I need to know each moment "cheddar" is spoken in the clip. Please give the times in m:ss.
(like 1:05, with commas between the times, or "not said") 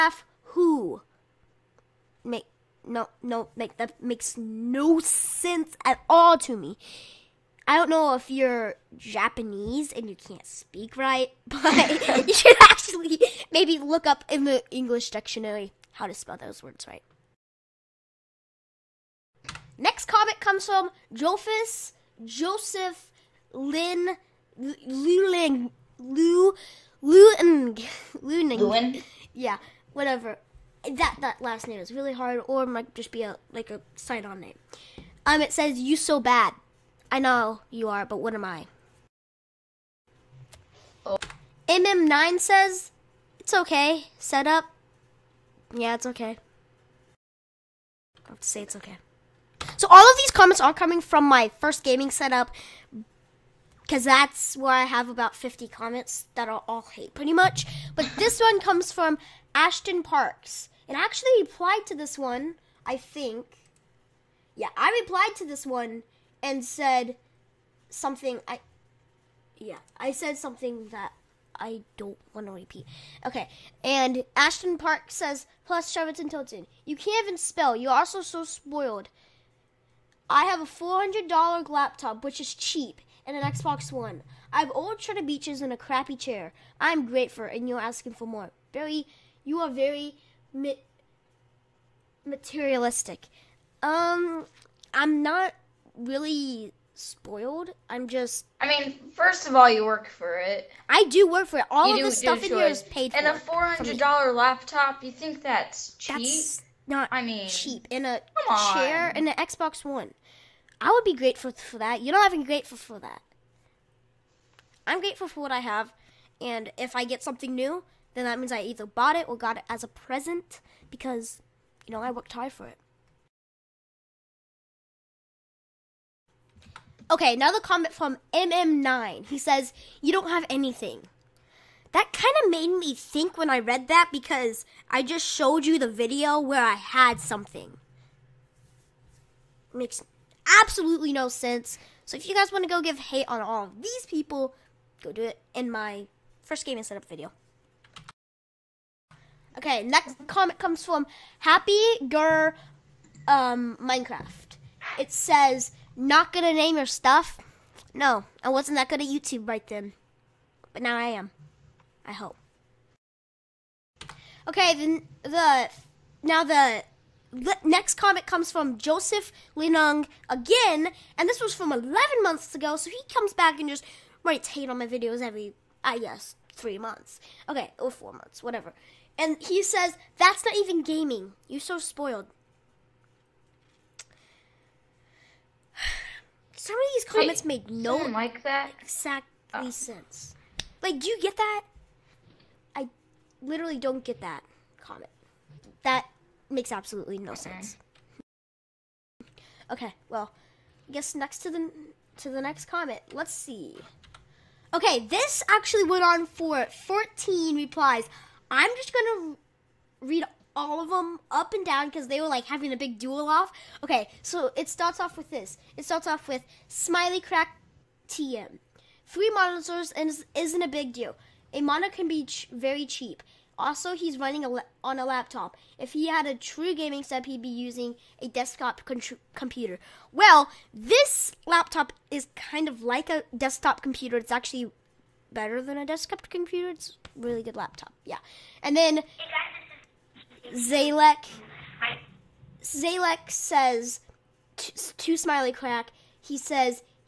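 1:24.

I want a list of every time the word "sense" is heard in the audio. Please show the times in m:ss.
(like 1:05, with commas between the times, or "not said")
0:04, 2:21, 3:09, 3:17.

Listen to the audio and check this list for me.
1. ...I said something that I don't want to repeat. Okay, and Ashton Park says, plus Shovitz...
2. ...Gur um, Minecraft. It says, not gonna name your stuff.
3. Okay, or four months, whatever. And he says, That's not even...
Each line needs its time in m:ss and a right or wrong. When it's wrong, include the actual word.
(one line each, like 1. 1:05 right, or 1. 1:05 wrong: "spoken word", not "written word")
1. 1:09 right
2. 2:32 right
3. 2:57 right.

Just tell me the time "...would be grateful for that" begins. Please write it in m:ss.
1:50.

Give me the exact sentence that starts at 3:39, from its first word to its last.
three monitors is, isn't a big deal a monitor can be ch very cheap.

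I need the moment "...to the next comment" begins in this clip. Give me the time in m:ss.
3:22.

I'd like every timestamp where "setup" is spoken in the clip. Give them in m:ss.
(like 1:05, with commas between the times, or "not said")
0:52, 2:26, 3:47.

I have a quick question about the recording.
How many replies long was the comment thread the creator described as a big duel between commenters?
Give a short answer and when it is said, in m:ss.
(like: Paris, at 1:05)
14, at 3:26.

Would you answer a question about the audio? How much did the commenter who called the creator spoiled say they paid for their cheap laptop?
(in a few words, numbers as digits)
$400.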